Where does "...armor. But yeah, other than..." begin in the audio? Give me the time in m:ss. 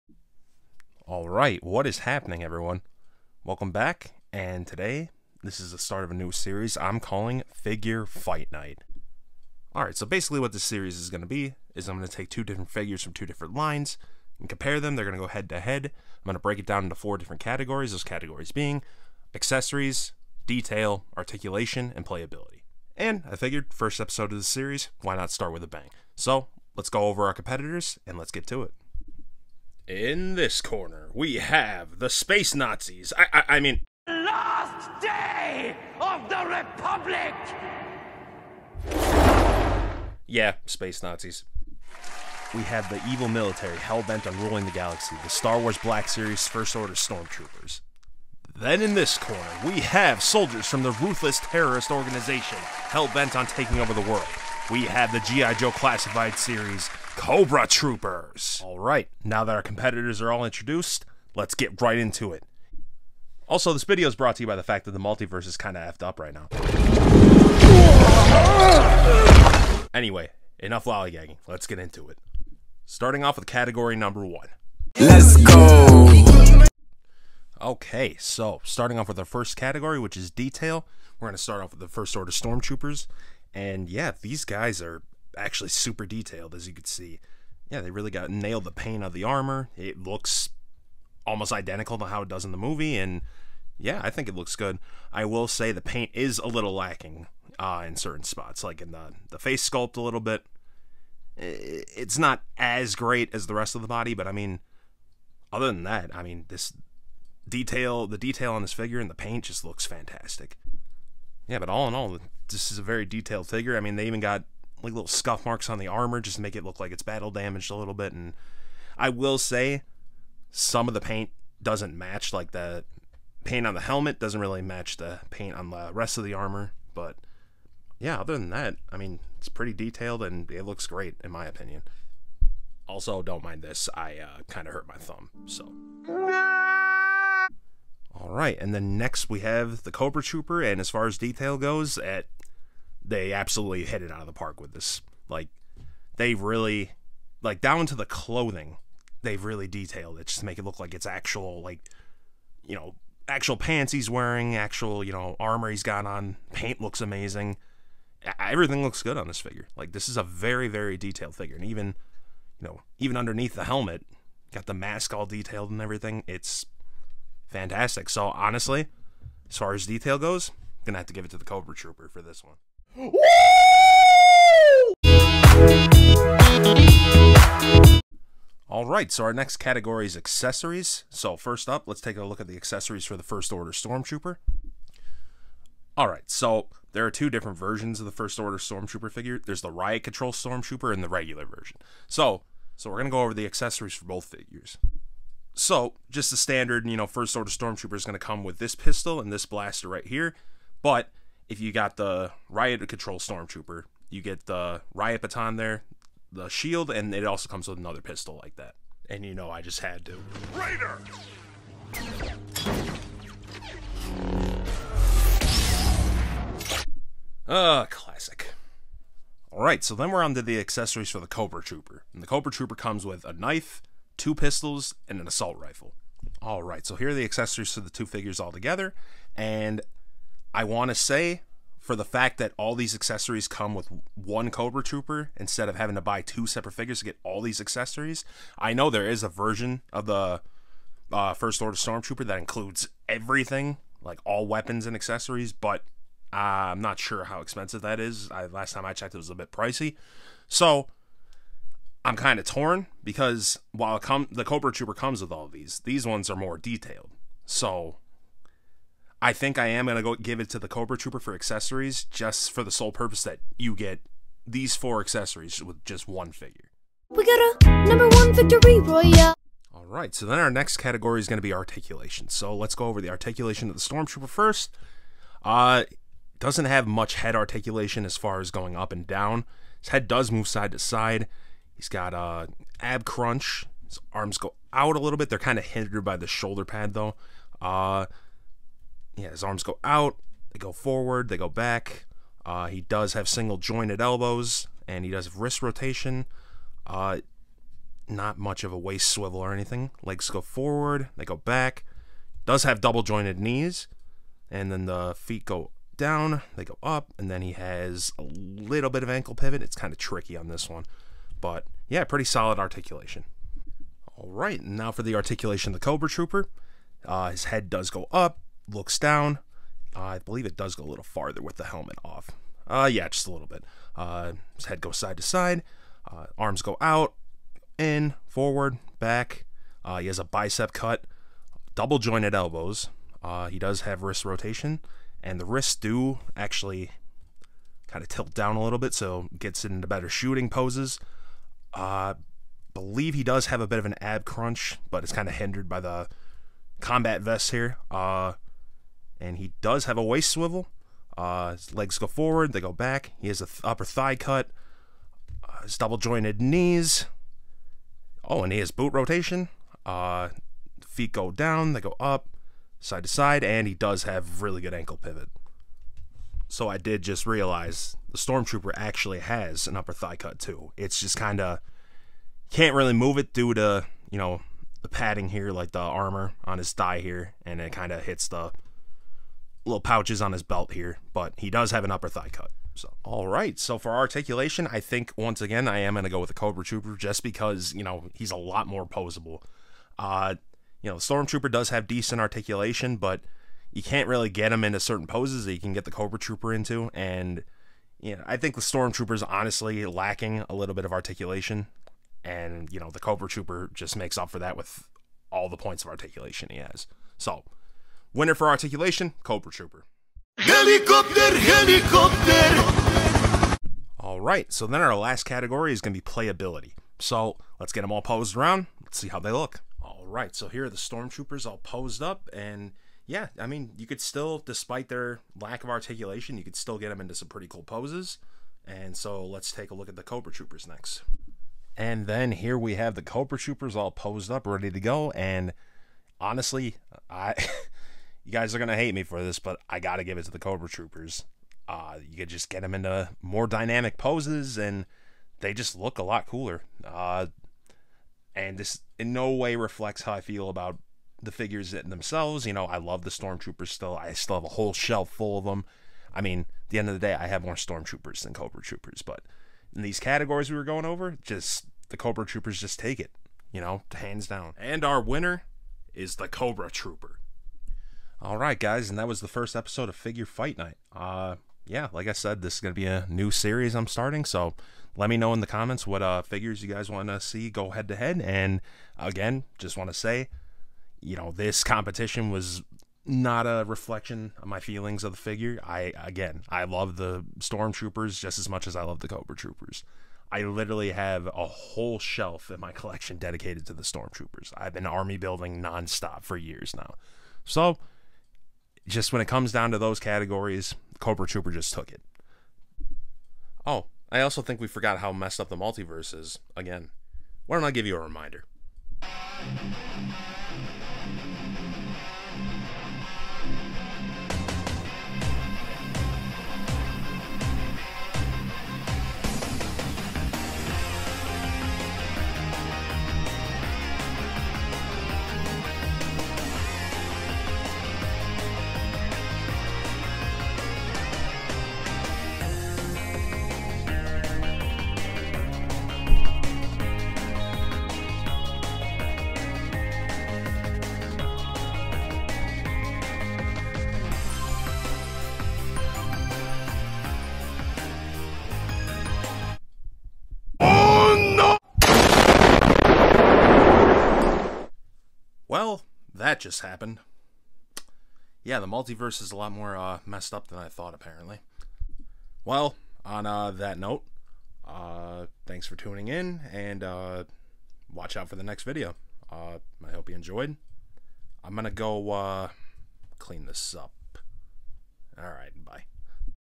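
2:06.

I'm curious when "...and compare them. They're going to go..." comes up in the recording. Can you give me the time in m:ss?
0:14.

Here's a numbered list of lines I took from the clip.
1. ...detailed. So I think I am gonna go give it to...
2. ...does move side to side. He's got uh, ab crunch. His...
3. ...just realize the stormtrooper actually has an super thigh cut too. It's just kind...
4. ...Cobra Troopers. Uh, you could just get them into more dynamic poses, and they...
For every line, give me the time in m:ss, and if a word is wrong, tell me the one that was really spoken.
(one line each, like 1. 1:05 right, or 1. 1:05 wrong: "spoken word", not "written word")
1. 4:16 right
2. 4:40 right
3. 6:07 wrong: "upper", not "super"
4. 7:20 right.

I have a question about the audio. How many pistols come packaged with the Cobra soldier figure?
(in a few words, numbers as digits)
2.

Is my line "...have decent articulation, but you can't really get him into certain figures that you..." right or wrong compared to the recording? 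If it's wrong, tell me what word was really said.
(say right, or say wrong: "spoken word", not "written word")
wrong: "poses", not "figures".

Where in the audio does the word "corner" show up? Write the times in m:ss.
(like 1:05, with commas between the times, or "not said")
0:30, 0:49.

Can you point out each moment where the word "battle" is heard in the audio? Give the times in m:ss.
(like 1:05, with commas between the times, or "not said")
1:57.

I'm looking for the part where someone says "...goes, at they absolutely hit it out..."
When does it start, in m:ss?
2:21.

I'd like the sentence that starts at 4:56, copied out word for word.
Uh, not much of a waist swivel or anything.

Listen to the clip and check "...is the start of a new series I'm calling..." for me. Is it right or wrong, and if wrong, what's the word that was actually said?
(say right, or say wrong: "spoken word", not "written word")
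right.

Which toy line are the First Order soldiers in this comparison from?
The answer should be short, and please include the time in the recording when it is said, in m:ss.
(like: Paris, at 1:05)
Star Wars Black Series, at 0:45.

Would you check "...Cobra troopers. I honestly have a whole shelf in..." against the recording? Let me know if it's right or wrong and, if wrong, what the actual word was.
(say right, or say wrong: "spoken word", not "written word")
wrong: "literally", not "honestly".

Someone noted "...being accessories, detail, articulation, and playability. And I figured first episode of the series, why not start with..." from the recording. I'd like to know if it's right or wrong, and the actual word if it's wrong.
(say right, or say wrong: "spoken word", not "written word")
right.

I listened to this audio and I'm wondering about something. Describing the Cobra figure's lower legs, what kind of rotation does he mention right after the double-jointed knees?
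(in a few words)
boot rotation.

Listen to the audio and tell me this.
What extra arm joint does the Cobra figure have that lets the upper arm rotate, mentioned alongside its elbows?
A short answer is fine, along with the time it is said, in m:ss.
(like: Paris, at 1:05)
bicep cut, at 5:30.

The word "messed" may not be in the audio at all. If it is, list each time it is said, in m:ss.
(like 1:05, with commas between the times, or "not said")
8:25, 9:20.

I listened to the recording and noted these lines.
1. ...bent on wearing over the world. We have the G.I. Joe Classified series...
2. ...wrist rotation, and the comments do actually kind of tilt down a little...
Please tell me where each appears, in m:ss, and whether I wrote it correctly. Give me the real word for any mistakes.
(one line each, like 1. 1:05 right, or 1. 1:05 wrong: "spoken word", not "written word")
1. 0:53 wrong: "taking", not "wearing"
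2. 5:34 wrong: "wrists", not "comments".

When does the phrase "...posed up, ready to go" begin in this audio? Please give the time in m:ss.
7:13.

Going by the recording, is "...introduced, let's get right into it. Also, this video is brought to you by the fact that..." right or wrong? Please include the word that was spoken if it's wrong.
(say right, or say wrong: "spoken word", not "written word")
right.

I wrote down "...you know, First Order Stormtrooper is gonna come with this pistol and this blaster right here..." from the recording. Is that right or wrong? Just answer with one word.
right.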